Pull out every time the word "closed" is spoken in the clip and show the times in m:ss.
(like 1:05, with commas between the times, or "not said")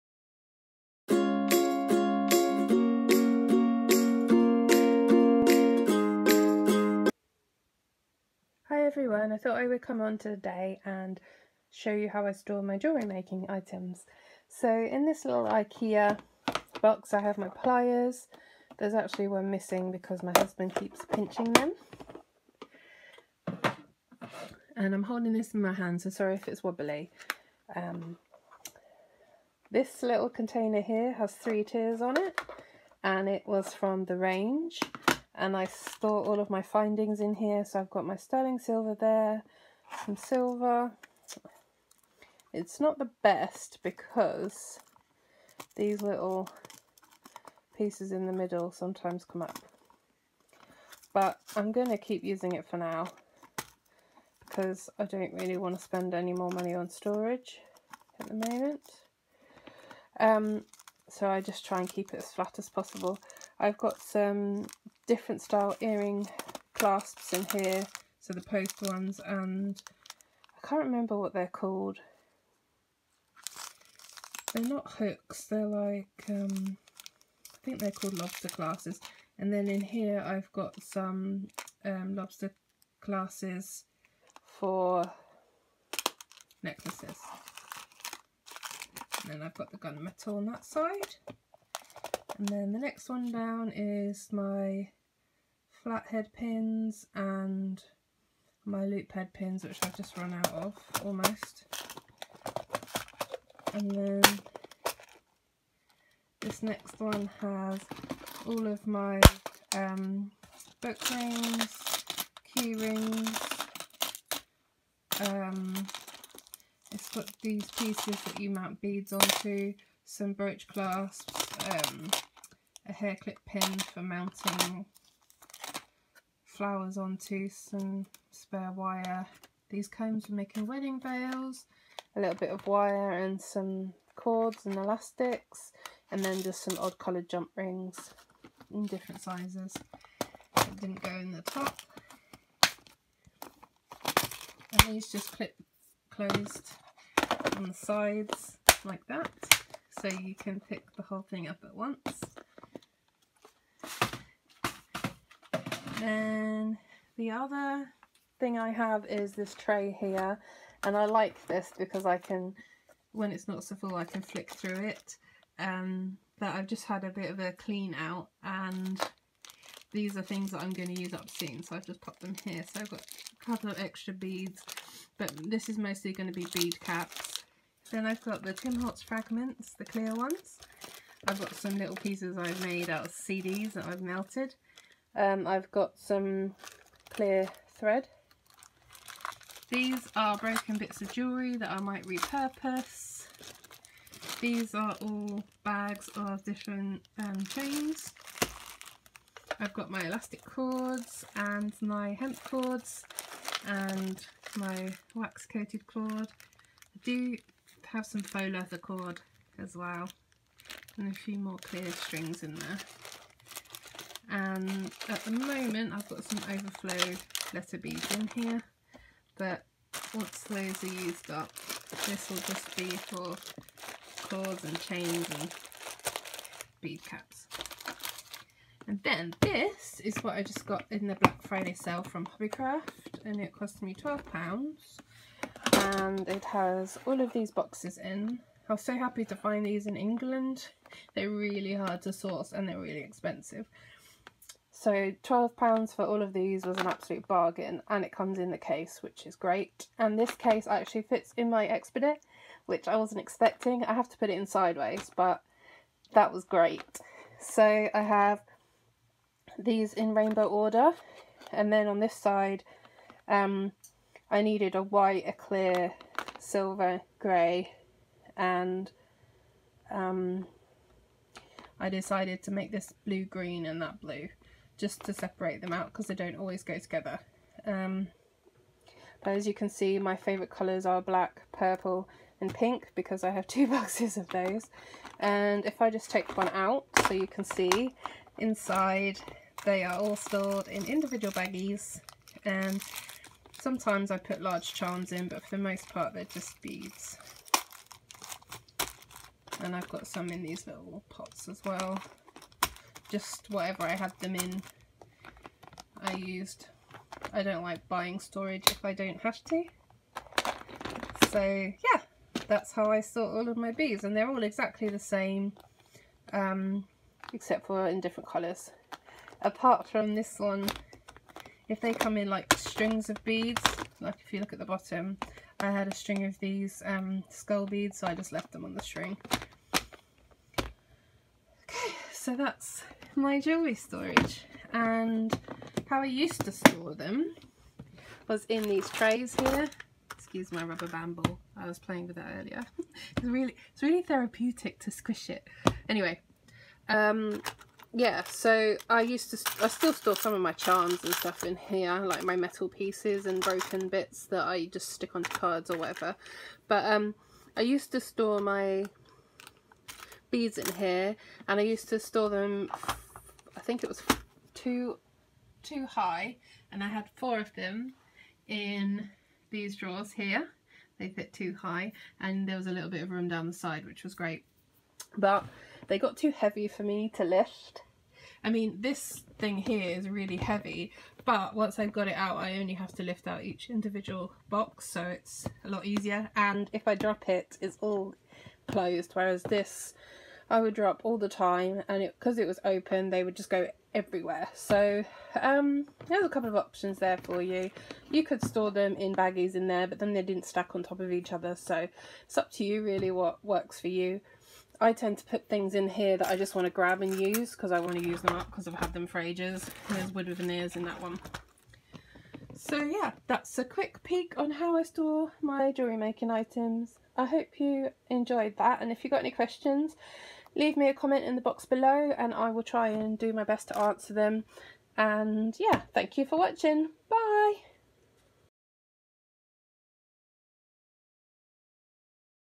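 2:26, 6:28.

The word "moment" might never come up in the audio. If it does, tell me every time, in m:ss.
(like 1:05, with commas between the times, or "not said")
0:58, 3:35.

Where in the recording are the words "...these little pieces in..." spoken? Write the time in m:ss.
0:45.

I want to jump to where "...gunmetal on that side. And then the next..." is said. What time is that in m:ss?
1:29.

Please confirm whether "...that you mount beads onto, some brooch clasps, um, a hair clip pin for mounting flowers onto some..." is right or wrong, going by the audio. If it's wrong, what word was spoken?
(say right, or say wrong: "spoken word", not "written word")
right.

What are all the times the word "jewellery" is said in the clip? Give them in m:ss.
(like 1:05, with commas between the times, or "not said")
0:12, 3:11, 5:33, 6:55.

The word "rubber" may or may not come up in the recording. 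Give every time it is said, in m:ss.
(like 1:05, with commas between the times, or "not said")
5:40.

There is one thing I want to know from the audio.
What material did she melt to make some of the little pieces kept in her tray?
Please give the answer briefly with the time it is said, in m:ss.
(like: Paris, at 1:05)
CDs, at 3:03.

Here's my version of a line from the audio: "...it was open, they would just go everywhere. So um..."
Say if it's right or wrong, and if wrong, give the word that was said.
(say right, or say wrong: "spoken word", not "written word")
right.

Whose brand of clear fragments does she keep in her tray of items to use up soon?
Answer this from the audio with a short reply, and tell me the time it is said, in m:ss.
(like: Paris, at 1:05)
Tim Holtz, at 2:58.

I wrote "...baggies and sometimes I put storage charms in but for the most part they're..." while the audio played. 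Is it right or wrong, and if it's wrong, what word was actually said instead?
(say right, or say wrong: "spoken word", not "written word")
wrong: "large", not "storage".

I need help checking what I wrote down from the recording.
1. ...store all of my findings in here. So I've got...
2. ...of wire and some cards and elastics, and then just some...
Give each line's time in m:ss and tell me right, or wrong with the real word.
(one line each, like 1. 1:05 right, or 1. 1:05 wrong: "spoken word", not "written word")
1. 0:35 right
2. 2:12 wrong: "cords", not "cards".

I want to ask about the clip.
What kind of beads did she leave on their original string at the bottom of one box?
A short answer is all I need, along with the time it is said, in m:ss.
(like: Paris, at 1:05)
skull beads, at 5:27.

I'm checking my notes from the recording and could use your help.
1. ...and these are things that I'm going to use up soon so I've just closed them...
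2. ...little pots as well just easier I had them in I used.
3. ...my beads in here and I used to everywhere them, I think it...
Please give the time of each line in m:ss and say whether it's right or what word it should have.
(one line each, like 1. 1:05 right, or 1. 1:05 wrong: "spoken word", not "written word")
1. 2:48 wrong: "popped", not "closed"
2. 5:00 wrong: "whatever", not "easier"
3. 5:58 wrong: "store", not "everywhere".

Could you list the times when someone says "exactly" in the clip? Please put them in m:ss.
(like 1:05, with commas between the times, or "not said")
5:14.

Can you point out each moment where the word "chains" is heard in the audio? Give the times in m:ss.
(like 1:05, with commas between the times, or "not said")
3:17, 3:44.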